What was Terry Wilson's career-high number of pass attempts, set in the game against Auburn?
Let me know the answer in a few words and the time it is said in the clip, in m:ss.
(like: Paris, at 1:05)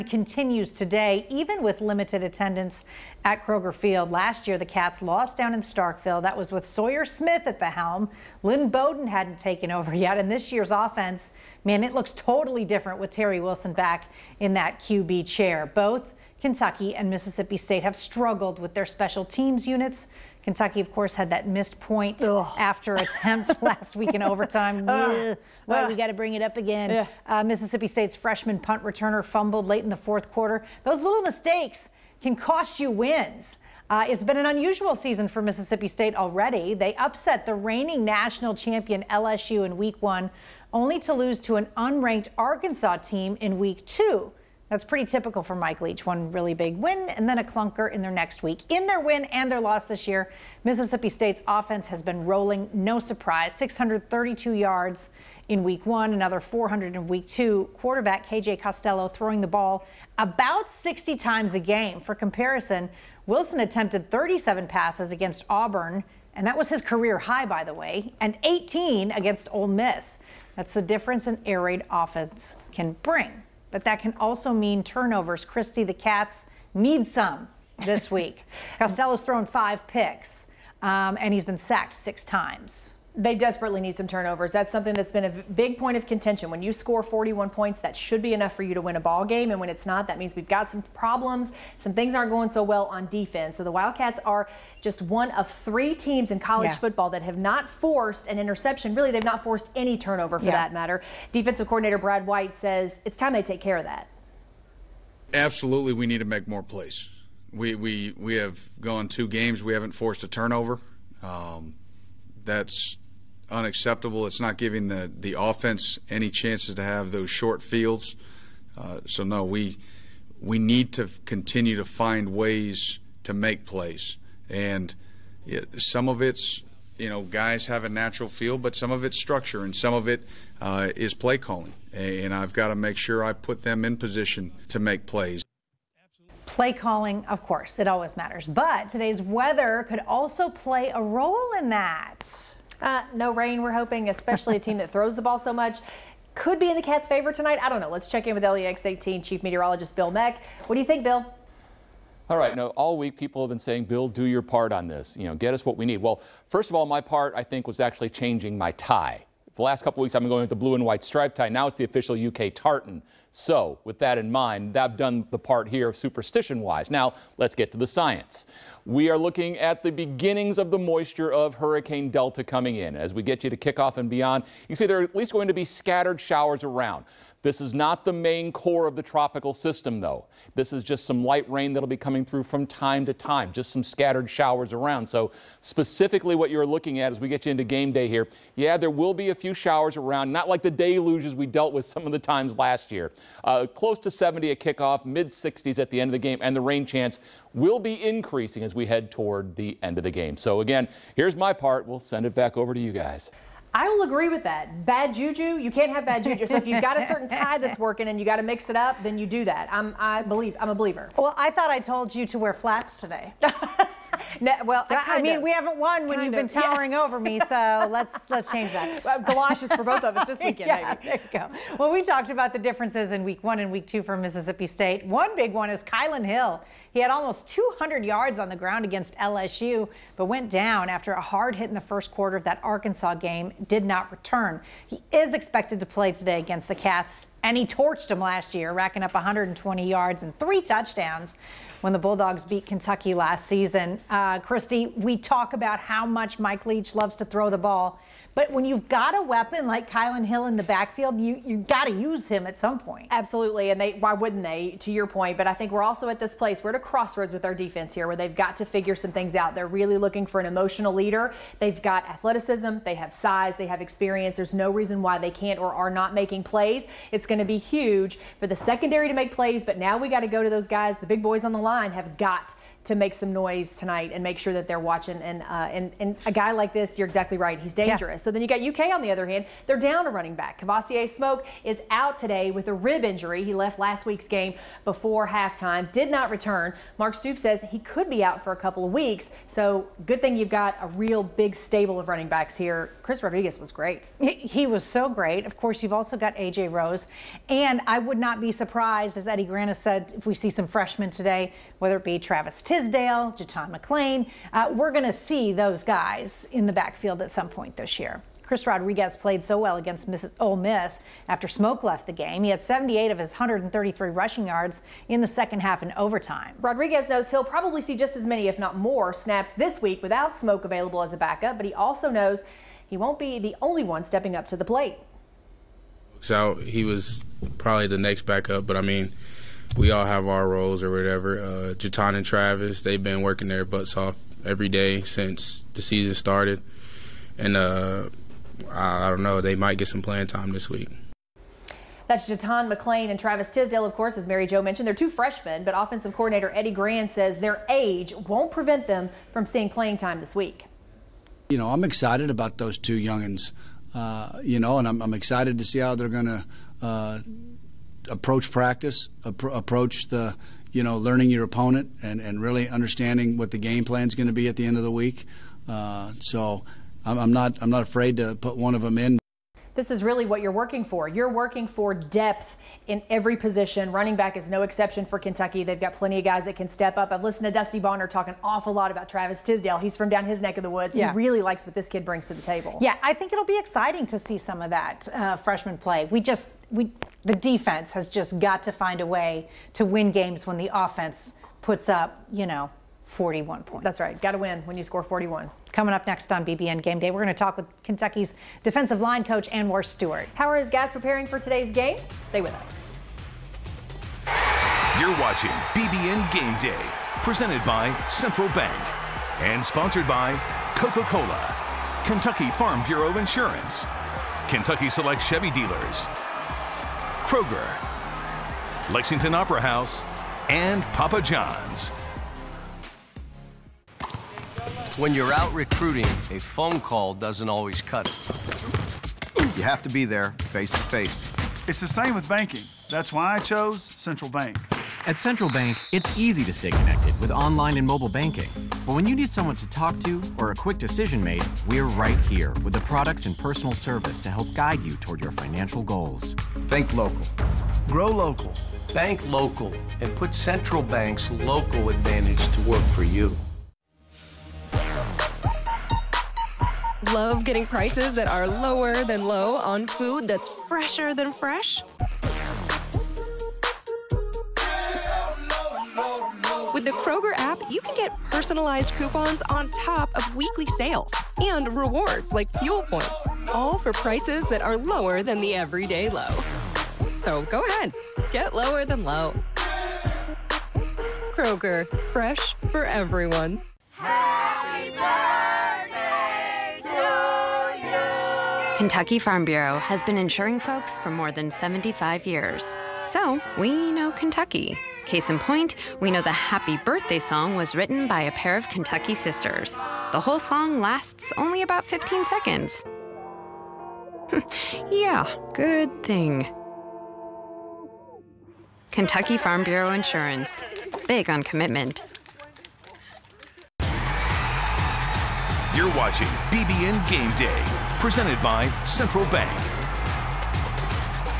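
37, at 1:04.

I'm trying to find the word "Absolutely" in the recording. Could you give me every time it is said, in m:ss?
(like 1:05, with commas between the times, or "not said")
1:45, 4:13.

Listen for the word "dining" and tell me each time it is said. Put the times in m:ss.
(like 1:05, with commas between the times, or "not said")
not said.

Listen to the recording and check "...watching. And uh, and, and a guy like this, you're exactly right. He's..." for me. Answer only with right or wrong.
right.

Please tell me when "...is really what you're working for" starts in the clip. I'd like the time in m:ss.
6:09.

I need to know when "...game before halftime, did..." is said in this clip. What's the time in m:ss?
4:44.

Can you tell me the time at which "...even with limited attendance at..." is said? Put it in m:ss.
0:01.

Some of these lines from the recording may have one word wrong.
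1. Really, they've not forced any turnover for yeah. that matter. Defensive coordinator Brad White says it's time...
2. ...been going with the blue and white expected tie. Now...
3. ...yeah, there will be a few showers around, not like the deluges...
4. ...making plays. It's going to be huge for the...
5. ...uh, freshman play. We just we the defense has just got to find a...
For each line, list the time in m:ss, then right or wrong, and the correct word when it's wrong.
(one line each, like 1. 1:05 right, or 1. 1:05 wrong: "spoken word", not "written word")
1. 1:38 right
2. 2:40 wrong: "striped", not "expected"
3. 3:08 right
4. 4:26 right
5. 6:25 right.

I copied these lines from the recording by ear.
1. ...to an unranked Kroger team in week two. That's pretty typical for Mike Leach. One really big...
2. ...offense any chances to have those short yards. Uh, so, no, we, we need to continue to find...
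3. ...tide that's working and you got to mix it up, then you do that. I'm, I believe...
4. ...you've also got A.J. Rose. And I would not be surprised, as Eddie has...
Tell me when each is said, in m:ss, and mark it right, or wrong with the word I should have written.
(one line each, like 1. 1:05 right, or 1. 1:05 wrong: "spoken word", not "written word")
1. 0:41 wrong: "Arkansas", not "Kroger"
2. 1:55 wrong: "fields", not "yards"
3. 3:27 right
4. 4:55 right.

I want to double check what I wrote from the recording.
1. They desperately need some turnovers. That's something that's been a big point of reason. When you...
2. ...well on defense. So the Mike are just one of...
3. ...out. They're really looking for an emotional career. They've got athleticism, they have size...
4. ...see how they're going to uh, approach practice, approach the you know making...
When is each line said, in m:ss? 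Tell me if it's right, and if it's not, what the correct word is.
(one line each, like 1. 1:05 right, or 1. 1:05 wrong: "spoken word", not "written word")
1. 1:23 wrong: "contention", not "reason"
2. 1:32 wrong: "Wildcats", not "Mike"
3. 4:19 wrong: "leader", not "career"
4. 5:55 wrong: "learning", not "making".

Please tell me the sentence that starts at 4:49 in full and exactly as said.
So good thing you've got a real big stable of running backs here.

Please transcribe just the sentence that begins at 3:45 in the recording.
One big one is Kylan Hill.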